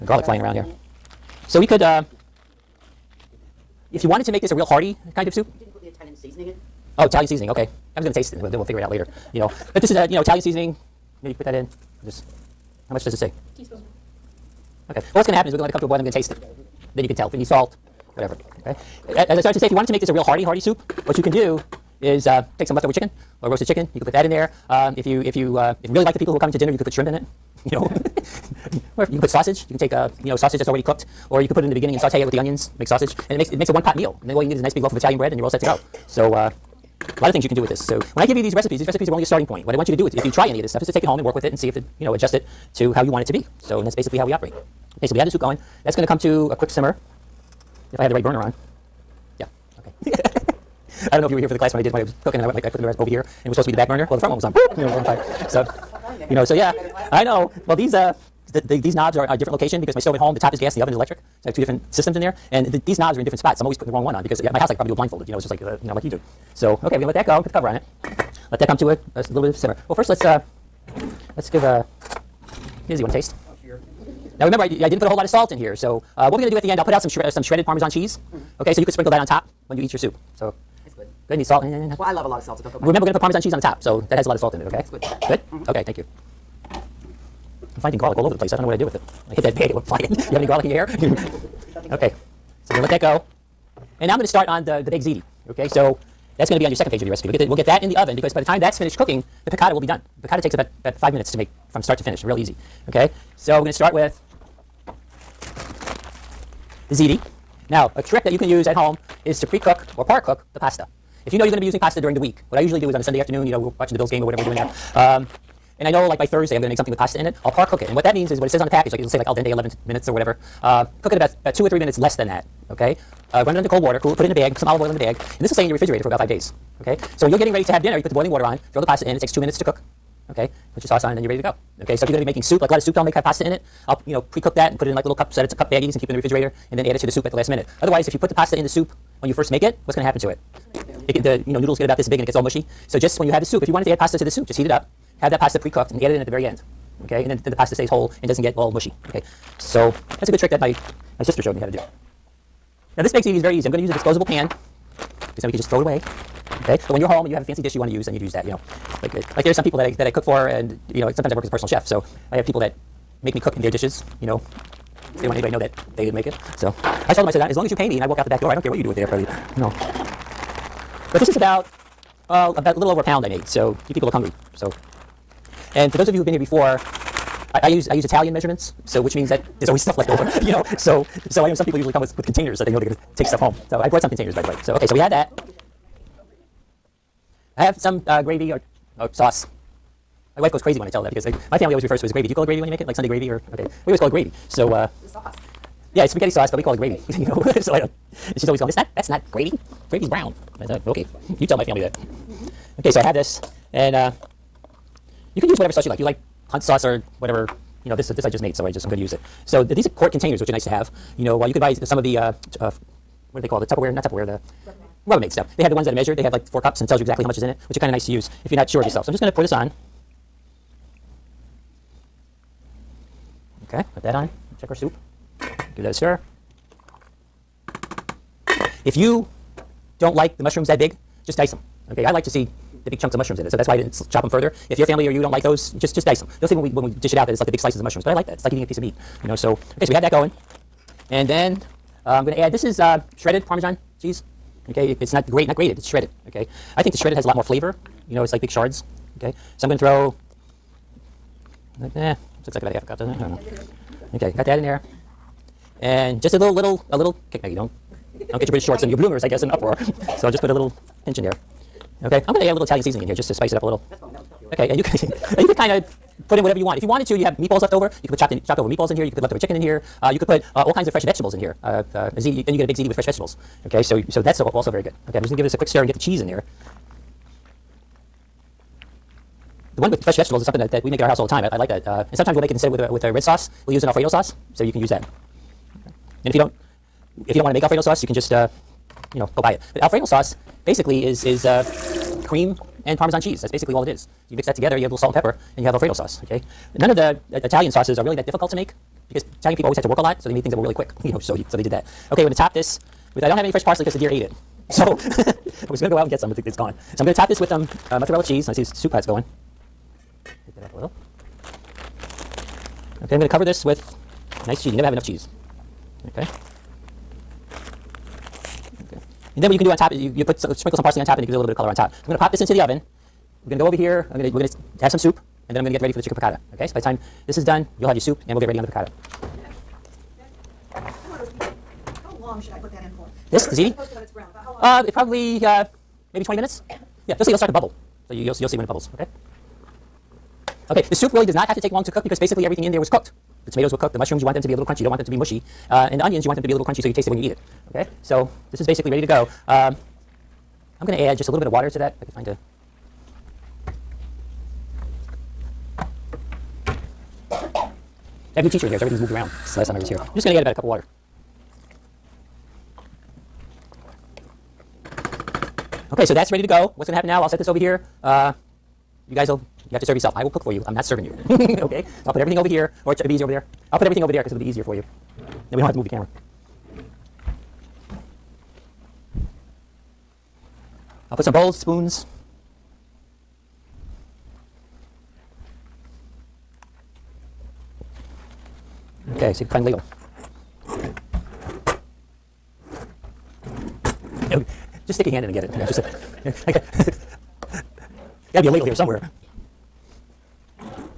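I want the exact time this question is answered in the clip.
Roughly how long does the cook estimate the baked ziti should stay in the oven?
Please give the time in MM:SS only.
05:36.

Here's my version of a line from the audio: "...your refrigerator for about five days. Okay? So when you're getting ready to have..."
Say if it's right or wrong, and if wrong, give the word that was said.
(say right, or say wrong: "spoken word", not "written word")
right.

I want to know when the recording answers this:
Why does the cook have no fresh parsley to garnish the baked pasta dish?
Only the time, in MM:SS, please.
05:03.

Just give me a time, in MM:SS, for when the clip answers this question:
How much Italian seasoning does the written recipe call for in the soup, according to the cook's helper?
00:13.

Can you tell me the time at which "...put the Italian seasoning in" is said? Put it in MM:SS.
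00:05.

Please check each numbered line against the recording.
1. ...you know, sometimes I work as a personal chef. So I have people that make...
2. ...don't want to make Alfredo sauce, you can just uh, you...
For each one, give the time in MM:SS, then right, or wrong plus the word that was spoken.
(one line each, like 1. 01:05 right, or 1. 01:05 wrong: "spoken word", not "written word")
1. 02:40 right
2. 04:47 right.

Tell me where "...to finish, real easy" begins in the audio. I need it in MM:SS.
01:41.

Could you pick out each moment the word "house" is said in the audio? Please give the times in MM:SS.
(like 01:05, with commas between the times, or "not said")
01:04, 04:41.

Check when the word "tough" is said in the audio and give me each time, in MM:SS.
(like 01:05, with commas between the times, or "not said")
not said.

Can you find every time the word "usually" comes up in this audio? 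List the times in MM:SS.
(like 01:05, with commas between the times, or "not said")
01:52, 03:01.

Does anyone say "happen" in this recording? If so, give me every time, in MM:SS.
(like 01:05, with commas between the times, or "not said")
00:15, 02:20, 06:06.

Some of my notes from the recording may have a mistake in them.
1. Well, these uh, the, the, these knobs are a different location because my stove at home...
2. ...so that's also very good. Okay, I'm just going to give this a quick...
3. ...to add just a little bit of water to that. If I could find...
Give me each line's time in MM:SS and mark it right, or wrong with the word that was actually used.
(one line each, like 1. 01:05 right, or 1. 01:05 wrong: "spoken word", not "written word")
1. 00:57 right
2. 04:34 right
3. 05:50 right.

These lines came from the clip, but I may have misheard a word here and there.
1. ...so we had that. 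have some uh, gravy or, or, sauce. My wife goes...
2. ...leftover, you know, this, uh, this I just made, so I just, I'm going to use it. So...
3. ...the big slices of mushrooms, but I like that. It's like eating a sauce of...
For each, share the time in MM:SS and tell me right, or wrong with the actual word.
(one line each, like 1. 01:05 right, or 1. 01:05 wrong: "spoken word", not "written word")
1. 03:04 right
2. 03:27 wrong: "whatever", not "leftover"
3. 03:57 wrong: "piece", not "sauce".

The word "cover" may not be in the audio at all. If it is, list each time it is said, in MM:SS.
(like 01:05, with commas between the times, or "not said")
01:07, 05:13.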